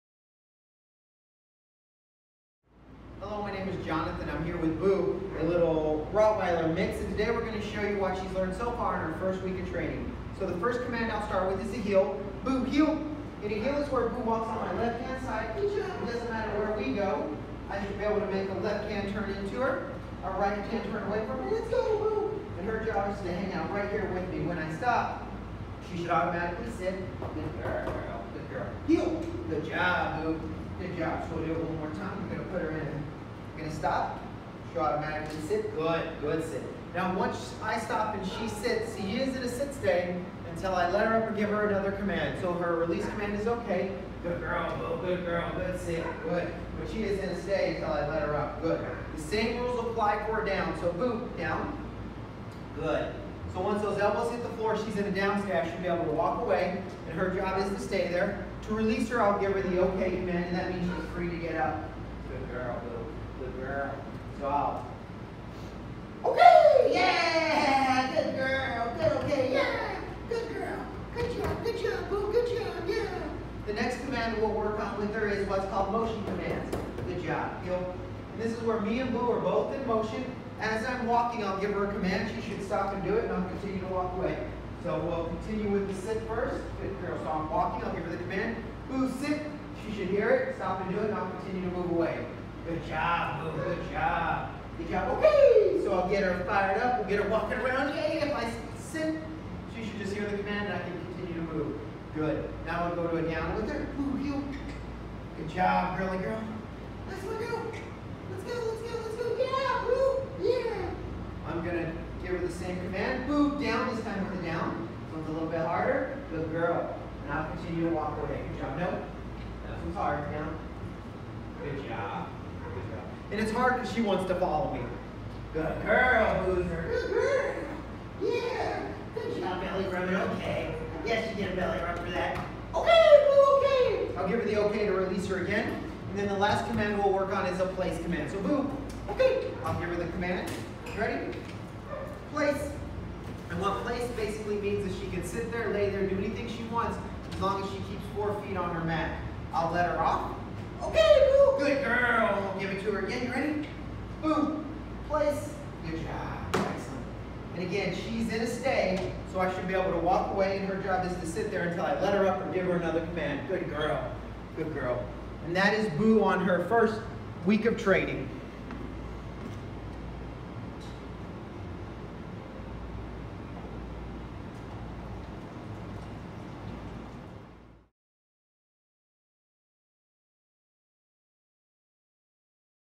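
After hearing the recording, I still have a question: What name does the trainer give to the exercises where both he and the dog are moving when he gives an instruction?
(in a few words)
motion commands.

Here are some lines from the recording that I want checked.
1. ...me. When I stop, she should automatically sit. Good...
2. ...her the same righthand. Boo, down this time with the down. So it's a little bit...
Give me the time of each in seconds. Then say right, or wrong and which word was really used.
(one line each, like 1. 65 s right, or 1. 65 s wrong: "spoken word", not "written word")
1. 24 s right
2. 112 s wrong: "command", not "righthand".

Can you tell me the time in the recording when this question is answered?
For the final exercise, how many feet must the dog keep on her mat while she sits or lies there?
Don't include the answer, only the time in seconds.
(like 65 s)
148 s.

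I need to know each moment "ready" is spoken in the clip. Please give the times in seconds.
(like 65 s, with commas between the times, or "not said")
140 s, 153 s.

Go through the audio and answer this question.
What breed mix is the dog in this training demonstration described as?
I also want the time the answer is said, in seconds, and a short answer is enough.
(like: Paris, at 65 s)
Rottweiler mix, at 6 s.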